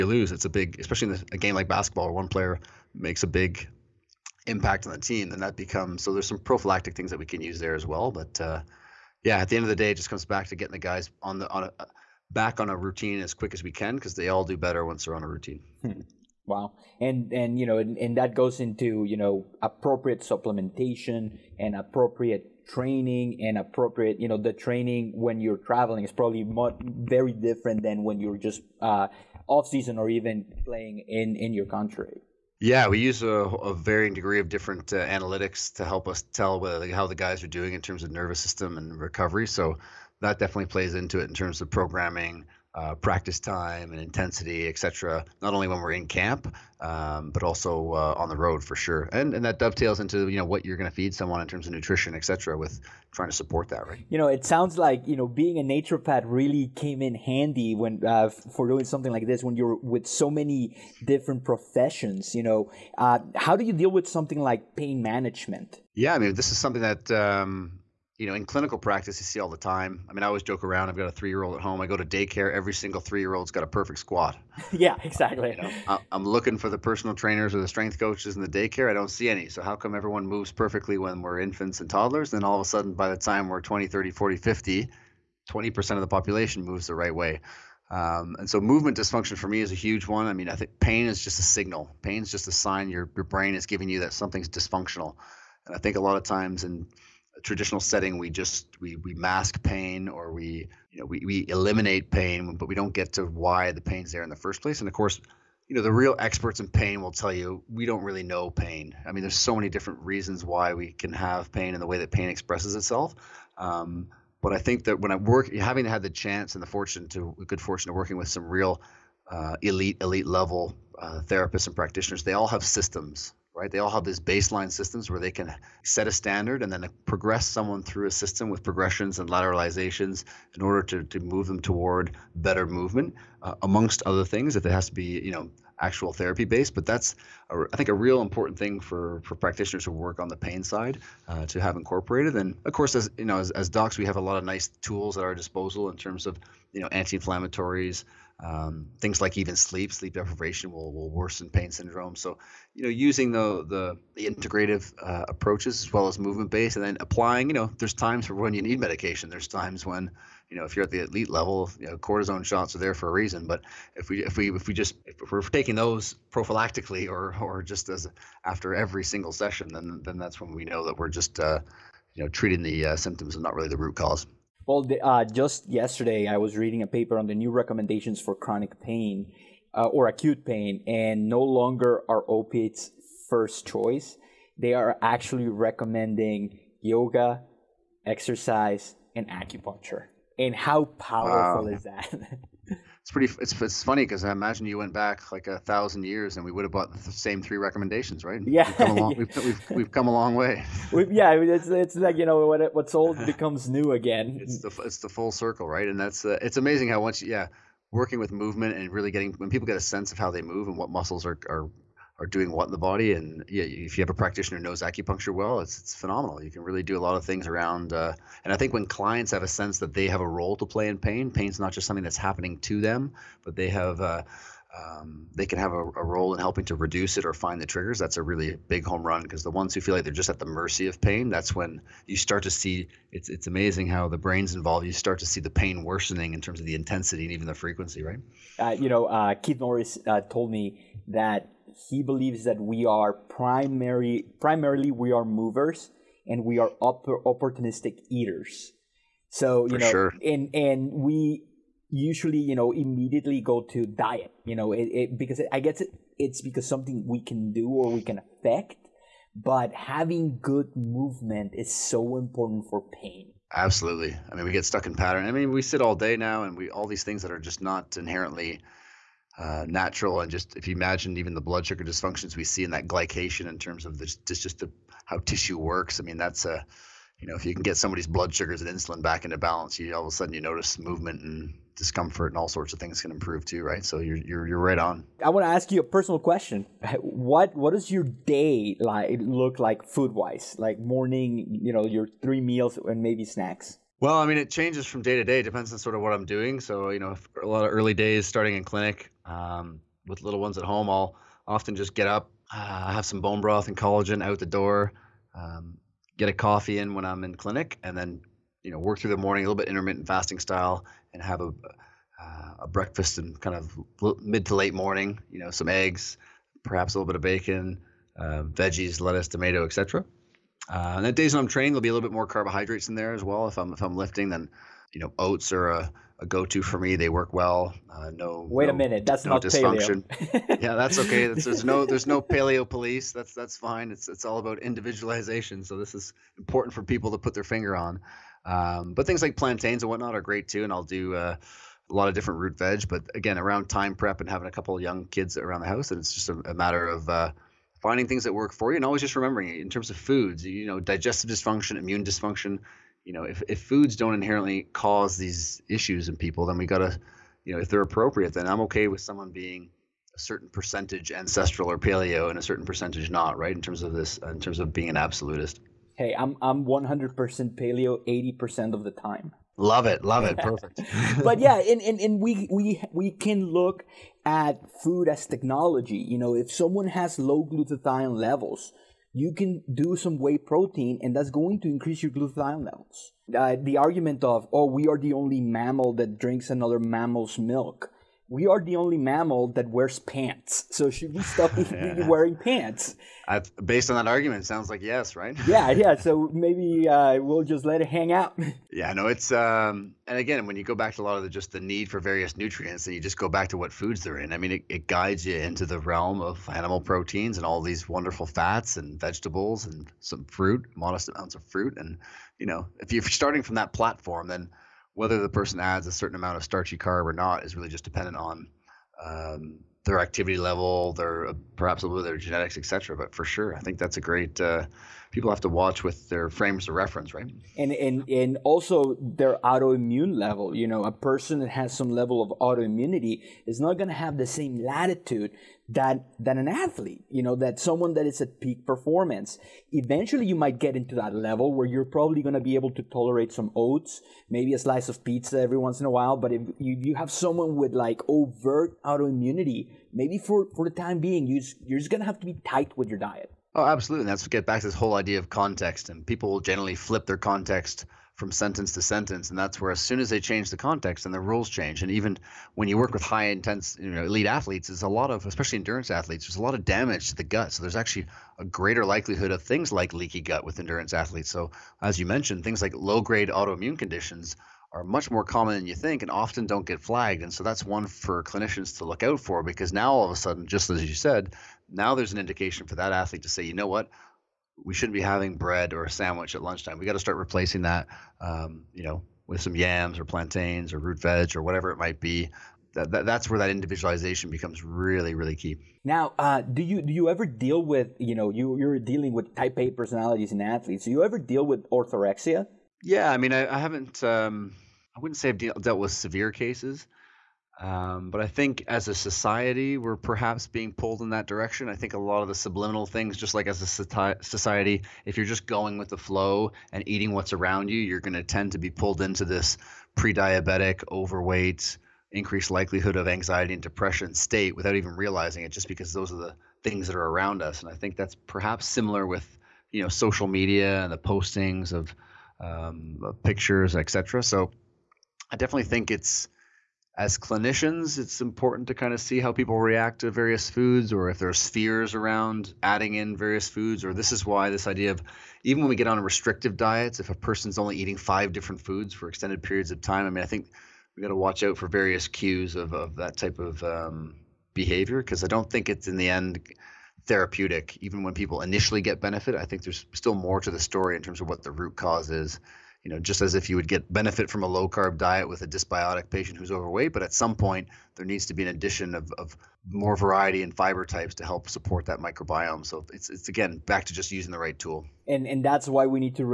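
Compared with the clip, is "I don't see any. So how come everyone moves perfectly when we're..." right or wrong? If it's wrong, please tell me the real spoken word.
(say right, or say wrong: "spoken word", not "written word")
right.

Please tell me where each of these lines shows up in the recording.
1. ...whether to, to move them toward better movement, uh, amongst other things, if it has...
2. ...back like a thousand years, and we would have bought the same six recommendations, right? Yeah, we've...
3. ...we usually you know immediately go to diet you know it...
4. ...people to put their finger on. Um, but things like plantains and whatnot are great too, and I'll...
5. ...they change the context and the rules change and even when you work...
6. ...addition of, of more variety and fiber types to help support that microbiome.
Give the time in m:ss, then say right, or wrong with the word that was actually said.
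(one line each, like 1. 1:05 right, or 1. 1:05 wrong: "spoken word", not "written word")
1. 2:10 wrong: "order", not "whether"
2. 3:14 wrong: "three", not "six"
3. 4:10 right
4. 5:36 right
5. 7:40 right
6. 9:28 right.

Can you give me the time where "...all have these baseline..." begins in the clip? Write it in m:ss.
2:03.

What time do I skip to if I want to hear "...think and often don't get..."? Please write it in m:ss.
7:55.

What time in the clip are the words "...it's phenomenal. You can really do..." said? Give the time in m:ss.
3:35.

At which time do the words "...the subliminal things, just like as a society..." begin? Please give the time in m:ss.
8:32.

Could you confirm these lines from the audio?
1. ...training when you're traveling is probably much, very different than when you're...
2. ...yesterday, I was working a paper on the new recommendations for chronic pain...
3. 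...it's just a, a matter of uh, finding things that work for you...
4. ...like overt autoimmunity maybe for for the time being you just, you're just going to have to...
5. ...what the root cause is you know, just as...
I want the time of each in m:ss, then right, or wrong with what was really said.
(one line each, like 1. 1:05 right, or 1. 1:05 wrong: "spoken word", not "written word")
1. 0:24 right
2. 2:55 wrong: "reading", not "working"
3. 5:45 right
4. 7:27 right
5. 9:21 right.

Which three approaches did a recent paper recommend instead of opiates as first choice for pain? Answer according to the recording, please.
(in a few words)
yoga, exercise, and acupuncture.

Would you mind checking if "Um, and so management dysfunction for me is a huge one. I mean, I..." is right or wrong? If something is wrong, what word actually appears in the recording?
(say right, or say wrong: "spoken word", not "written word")
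wrong: "movement", not "management".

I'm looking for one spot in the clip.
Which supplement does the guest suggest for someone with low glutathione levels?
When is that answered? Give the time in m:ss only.
6:20.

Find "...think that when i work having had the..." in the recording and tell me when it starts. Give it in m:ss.
1:54.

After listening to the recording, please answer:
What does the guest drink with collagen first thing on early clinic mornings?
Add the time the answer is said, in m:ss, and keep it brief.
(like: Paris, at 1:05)
bone broth, at 5:03.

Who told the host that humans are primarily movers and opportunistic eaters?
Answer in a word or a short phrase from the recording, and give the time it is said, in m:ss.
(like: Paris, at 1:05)
Keith Norris, at 3:59.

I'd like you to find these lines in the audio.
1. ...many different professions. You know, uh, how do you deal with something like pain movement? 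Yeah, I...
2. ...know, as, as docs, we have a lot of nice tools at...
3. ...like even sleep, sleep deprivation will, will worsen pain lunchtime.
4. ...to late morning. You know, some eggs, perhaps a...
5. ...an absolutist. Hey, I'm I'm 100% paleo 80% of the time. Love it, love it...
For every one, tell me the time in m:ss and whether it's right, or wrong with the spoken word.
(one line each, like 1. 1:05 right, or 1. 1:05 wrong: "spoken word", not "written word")
1. 1:00 wrong: "management", not "movement"
2. 2:23 right
3. 2:29 wrong: "syndrome", not "lunchtime"
4. 5:14 right
5. 6:04 right.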